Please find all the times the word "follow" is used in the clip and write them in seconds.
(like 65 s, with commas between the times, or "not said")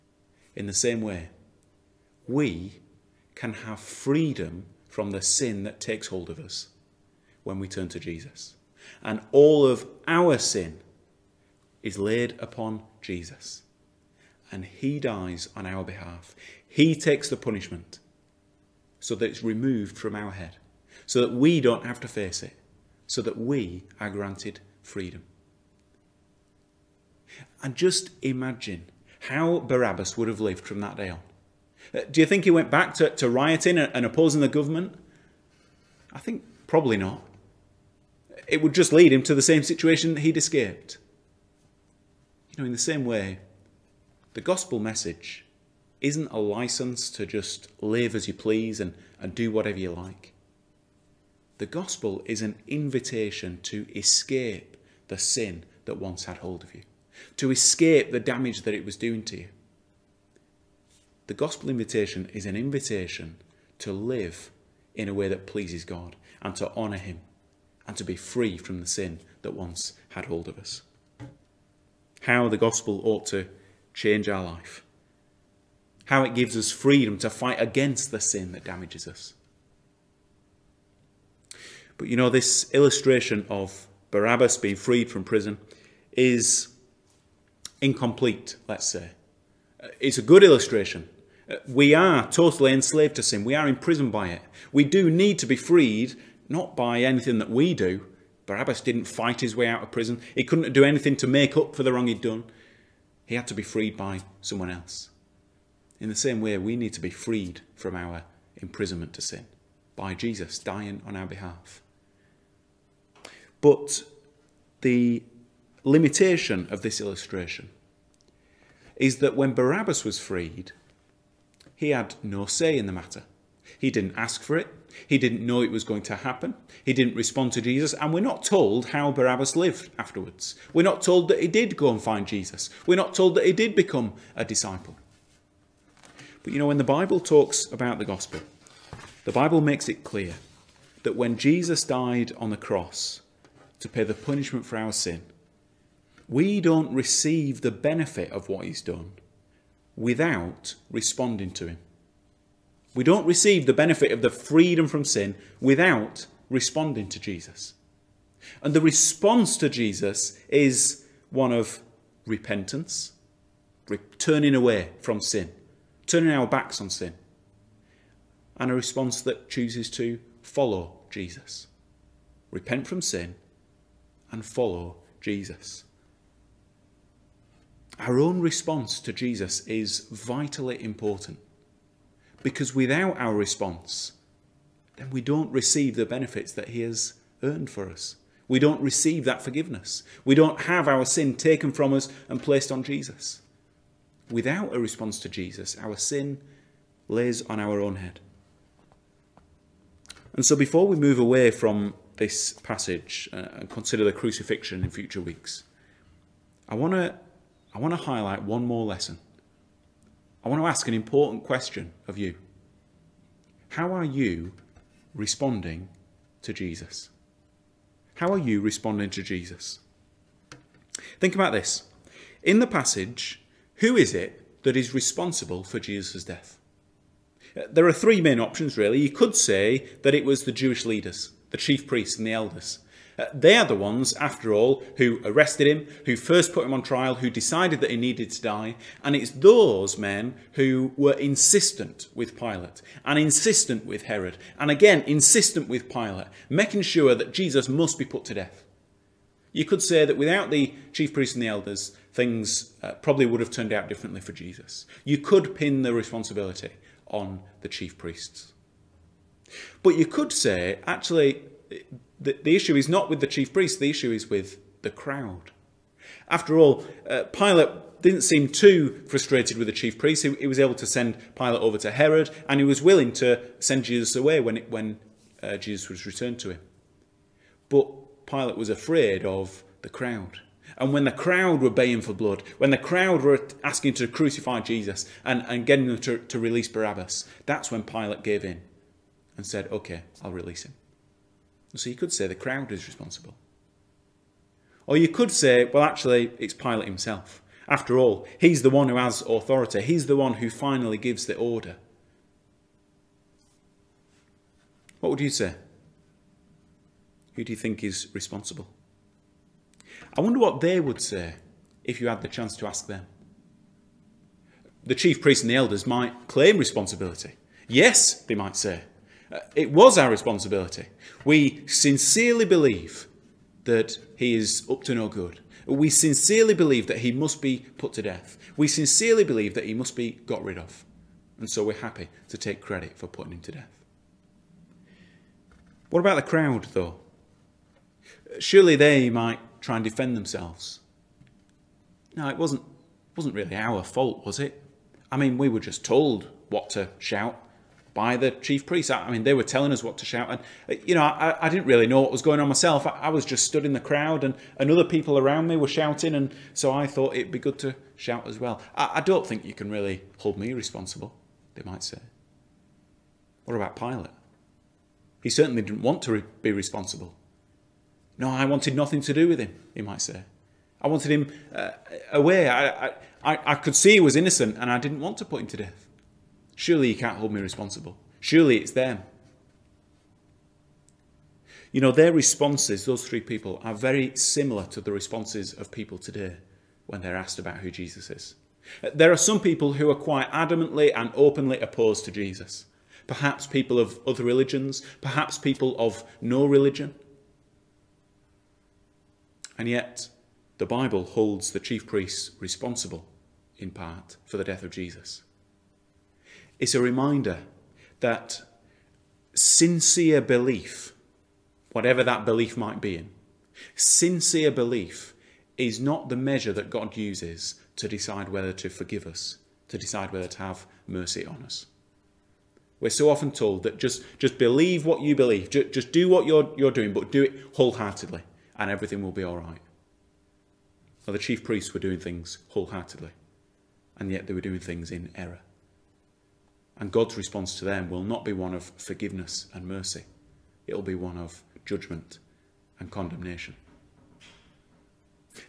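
170 s, 174 s.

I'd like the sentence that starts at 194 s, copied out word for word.
Without a response to Jesus, our sin lays on our own head.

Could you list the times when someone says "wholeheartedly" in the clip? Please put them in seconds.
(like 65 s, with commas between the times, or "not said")
427 s, 432 s.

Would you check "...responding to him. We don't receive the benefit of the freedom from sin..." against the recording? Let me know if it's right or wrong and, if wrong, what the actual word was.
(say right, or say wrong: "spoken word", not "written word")
right.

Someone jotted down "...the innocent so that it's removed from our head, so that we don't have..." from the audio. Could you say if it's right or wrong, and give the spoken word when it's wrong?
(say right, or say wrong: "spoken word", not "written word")
wrong: "punishment", not "innocent".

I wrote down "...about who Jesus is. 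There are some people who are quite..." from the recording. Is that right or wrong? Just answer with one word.
right.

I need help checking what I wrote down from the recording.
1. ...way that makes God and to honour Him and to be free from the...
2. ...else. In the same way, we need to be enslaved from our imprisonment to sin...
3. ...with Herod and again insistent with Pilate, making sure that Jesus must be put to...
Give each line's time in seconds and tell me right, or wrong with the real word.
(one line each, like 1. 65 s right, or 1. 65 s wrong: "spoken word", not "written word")
1. 65 s wrong: "pleases", not "makes"
2. 104 s wrong: "freed", not "enslaved"
3. 243 s right.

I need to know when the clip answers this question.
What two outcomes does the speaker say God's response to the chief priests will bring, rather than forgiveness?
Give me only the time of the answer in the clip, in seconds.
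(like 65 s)
441 s.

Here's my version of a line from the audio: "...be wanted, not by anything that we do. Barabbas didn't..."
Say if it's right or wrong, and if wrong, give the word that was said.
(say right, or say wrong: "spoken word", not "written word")
wrong: "freed", not "wanted".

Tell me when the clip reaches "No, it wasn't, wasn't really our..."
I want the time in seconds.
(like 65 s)
342 s.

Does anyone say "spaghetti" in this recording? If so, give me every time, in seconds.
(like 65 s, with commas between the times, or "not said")
not said.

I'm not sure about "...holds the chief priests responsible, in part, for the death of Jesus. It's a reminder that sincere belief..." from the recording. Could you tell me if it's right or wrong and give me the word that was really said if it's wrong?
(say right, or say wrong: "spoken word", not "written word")
right.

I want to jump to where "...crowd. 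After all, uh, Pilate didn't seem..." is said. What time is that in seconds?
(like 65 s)
264 s.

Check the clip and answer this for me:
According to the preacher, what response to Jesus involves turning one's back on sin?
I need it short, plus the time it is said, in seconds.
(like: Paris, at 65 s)
Repentance, at 162 s.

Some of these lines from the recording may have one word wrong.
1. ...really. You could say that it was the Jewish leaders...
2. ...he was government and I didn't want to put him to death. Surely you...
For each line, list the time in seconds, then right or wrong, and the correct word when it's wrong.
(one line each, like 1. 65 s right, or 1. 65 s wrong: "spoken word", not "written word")
1. 228 s right
2. 373 s wrong: "innocent", not "government".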